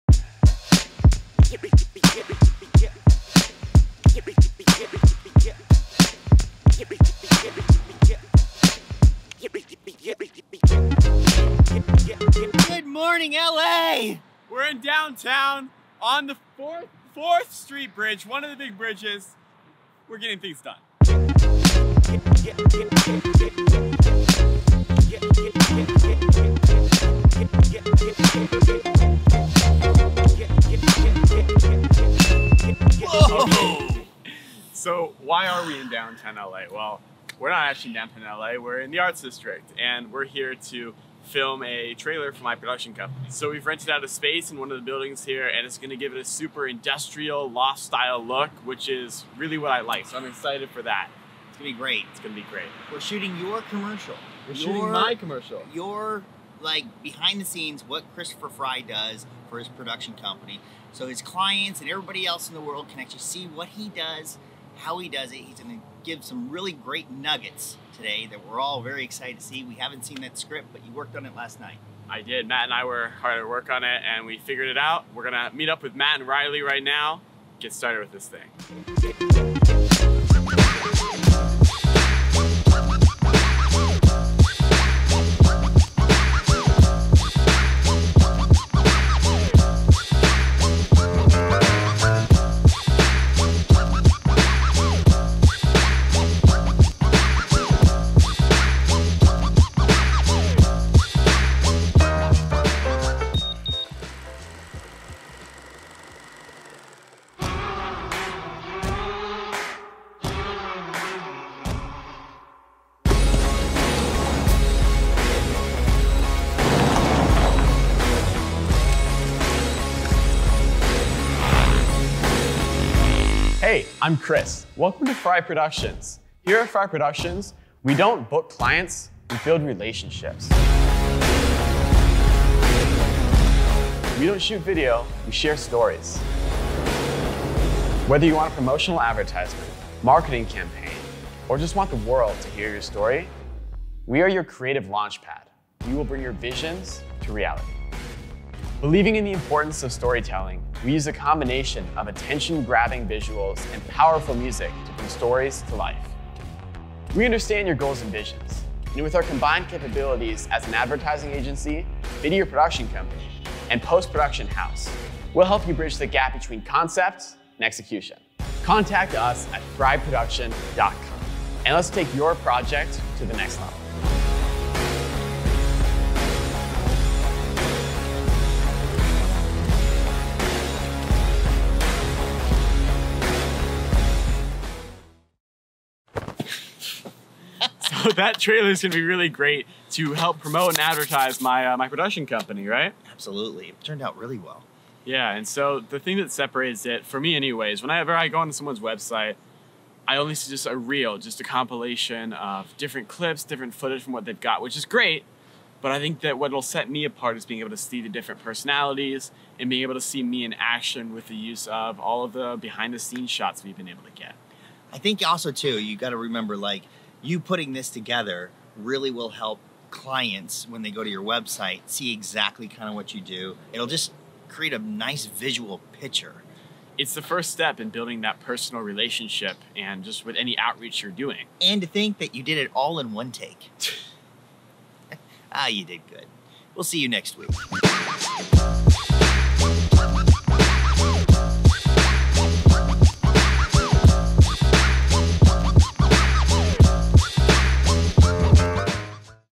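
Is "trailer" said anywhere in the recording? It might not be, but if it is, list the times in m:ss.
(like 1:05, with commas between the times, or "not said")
0:41, 3:08.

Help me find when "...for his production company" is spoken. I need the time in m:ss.
0:59.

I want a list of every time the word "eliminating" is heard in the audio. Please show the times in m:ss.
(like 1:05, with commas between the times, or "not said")
not said.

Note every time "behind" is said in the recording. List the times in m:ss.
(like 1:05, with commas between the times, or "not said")
0:57, 3:32.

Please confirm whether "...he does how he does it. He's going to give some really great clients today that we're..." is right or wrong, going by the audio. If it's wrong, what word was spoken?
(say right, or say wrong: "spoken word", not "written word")
wrong: "nuggets", not "clients".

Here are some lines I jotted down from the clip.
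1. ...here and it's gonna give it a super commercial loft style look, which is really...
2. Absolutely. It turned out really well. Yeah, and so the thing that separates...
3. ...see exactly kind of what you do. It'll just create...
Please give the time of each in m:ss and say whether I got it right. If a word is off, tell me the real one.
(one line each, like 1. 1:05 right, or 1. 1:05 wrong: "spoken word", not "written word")
1. 0:45 wrong: "industrial", not "commercial"
2. 3:13 right
3. 3:41 right.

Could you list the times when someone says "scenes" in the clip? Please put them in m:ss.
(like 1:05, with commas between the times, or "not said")
0:57, 3:32.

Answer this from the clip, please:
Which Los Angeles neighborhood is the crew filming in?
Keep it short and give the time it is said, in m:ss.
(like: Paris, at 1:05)
Arts District, at 0:38.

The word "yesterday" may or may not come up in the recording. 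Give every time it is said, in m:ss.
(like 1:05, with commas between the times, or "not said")
not said.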